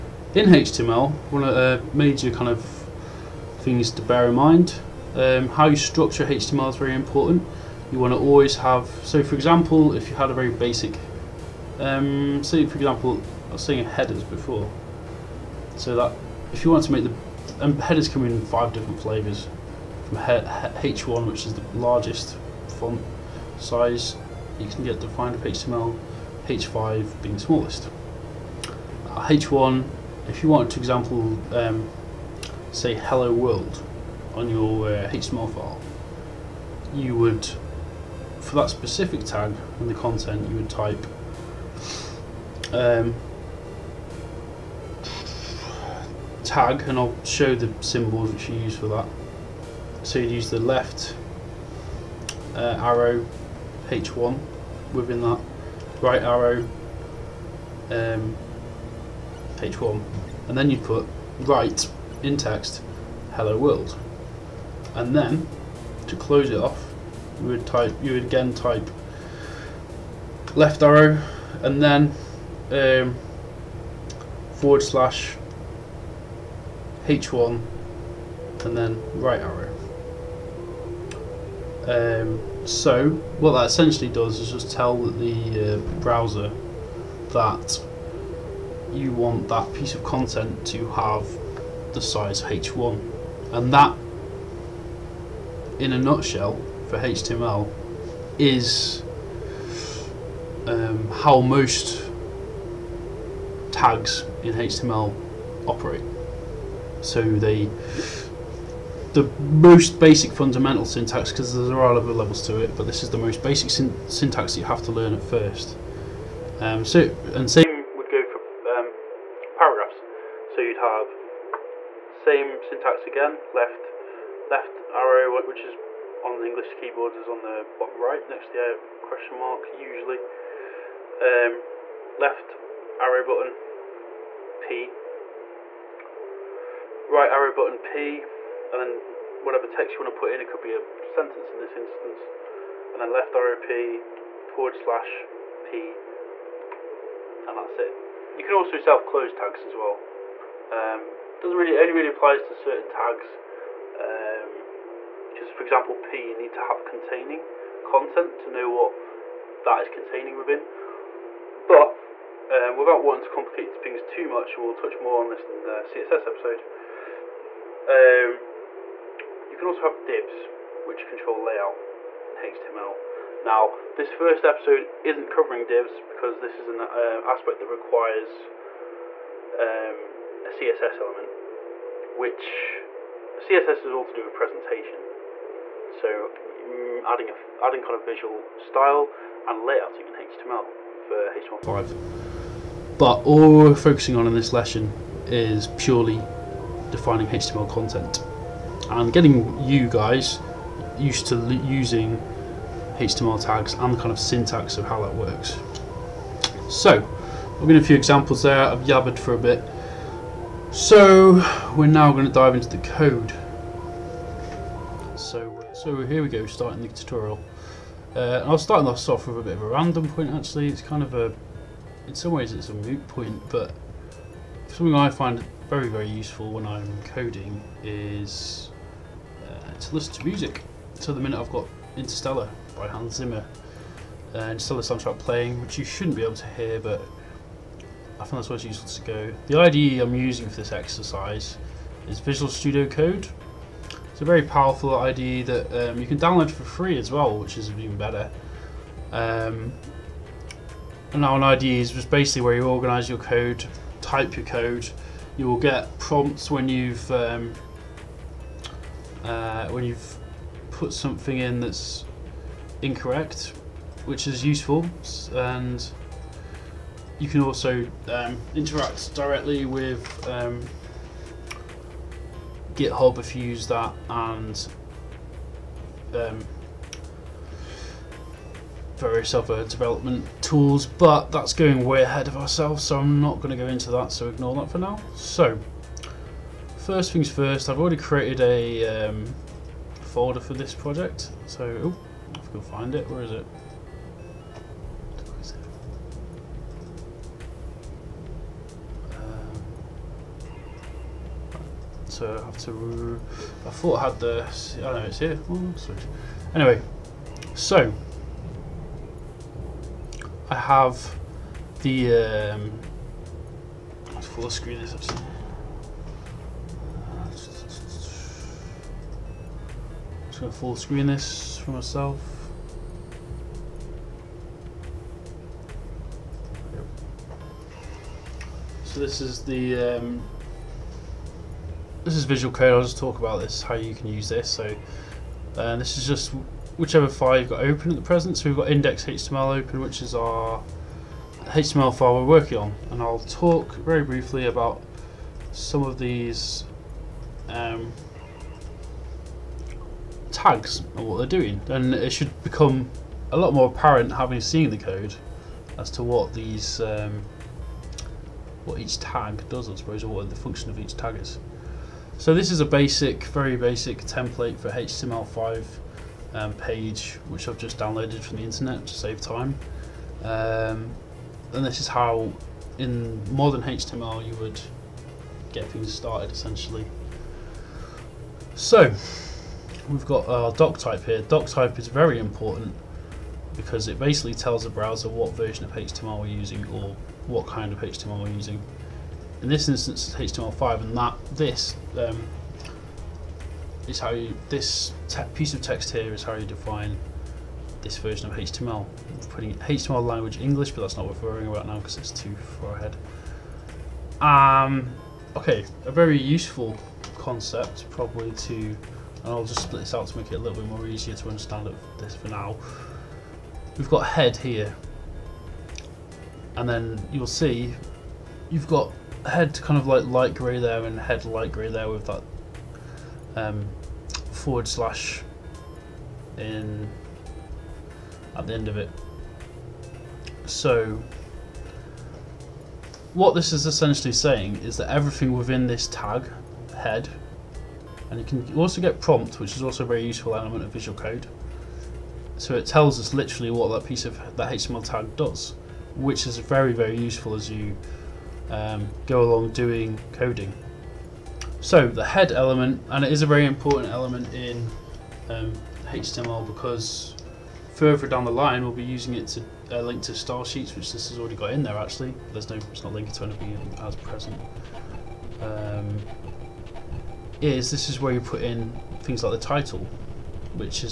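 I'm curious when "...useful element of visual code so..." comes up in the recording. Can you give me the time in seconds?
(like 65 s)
440 s.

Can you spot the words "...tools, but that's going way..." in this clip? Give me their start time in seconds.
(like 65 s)
280 s.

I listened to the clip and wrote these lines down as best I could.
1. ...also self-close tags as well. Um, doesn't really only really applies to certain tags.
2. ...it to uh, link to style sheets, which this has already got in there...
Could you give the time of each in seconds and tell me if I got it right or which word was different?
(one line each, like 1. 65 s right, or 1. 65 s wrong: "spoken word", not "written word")
1. 148 s right
2. 459 s right.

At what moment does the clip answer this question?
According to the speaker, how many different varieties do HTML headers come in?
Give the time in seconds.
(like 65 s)
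18 s.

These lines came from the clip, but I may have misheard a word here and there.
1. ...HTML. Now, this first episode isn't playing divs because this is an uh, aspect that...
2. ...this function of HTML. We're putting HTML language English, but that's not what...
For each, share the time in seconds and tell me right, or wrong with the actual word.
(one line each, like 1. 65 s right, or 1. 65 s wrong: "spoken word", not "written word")
1. 172 s wrong: "covering", not "playing"
2. 397 s wrong: "version", not "function".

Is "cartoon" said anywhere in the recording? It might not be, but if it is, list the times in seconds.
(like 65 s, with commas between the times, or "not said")
not said.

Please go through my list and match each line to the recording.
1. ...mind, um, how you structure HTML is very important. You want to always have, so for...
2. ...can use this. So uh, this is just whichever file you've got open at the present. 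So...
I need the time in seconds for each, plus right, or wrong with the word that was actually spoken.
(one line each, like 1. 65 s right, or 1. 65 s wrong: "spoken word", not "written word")
1. 4 s right
2. 333 s right.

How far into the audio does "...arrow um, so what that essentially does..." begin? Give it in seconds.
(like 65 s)
79 s.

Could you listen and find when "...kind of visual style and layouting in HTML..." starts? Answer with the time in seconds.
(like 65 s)
187 s.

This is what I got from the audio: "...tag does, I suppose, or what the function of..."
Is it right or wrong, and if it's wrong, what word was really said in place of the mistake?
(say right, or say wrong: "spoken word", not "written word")
right.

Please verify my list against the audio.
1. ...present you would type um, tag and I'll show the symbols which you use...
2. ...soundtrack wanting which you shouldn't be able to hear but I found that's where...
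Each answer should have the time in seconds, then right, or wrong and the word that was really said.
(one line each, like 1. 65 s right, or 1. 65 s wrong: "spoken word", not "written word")
1. 39 s wrong: "content", not "present"
2. 234 s wrong: "playing", not "wanting".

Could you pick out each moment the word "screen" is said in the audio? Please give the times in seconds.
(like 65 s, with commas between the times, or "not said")
314 s, 320 s.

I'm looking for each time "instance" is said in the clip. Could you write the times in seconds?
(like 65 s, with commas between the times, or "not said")
141 s, 389 s.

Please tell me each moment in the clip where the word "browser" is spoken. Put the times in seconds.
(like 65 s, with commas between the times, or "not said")
86 s, 384 s.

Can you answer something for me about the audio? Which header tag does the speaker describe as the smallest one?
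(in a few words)
H5.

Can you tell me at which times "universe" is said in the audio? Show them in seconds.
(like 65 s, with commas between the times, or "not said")
not said.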